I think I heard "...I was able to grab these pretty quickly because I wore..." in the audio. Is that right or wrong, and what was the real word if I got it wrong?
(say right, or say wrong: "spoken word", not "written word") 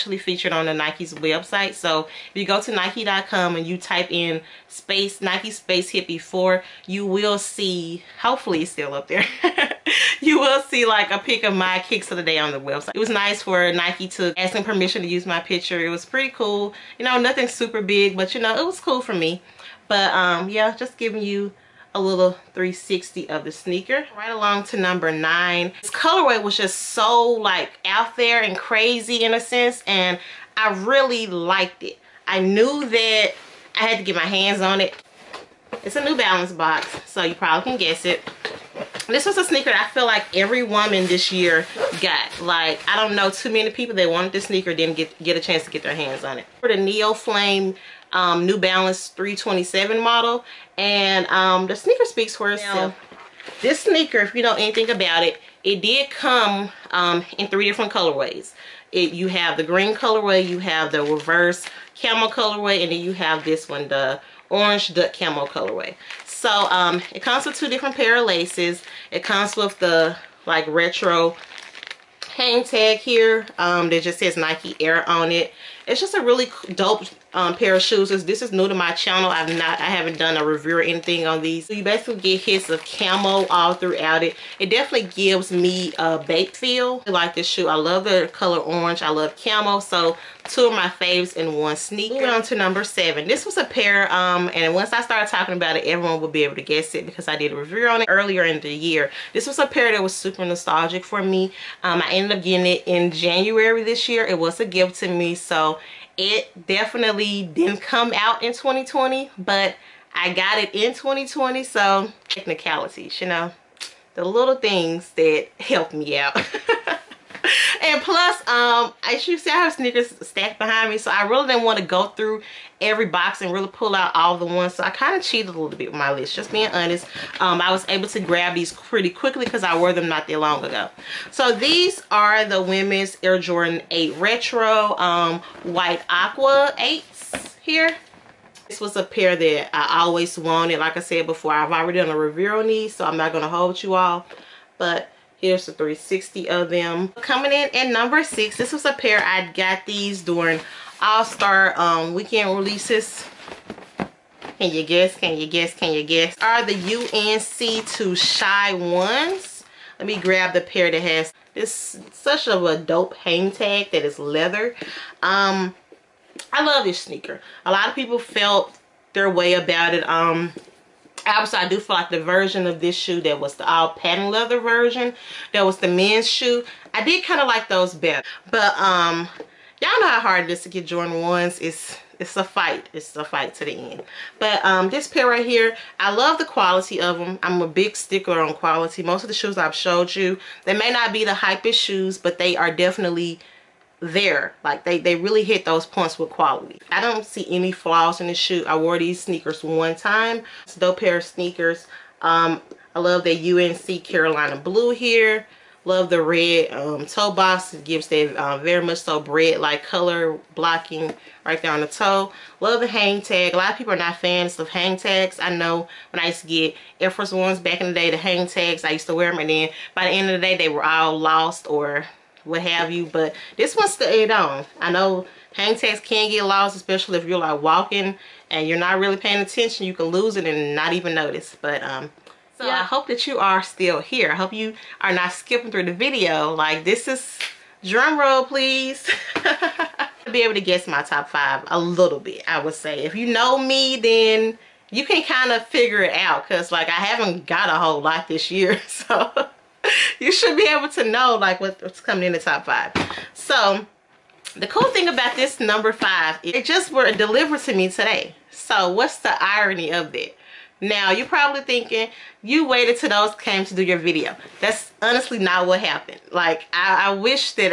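right.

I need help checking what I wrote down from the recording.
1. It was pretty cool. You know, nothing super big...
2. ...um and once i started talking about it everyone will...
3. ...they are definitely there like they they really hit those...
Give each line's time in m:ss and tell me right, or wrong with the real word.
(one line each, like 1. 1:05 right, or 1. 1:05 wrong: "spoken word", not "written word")
1. 0:15 right
2. 1:34 right
3. 3:12 right.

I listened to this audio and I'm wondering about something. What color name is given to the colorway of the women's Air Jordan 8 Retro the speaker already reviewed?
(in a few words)
White Aqua.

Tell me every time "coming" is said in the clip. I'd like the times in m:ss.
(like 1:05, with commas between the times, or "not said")
2:27, 4:12.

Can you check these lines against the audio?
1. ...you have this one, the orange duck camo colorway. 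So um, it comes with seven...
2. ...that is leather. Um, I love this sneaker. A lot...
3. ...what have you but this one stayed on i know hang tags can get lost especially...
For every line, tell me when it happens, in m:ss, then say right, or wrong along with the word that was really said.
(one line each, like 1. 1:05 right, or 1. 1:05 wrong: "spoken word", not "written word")
1. 1:03 wrong: "two", not "seven"
2. 2:43 right
3. 3:42 right.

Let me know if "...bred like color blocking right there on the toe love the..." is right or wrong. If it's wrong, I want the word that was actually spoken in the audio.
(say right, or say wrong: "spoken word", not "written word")
right.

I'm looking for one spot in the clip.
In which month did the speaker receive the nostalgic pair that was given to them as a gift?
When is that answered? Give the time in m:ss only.
1:43.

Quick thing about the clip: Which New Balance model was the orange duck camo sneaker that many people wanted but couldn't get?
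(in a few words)
327.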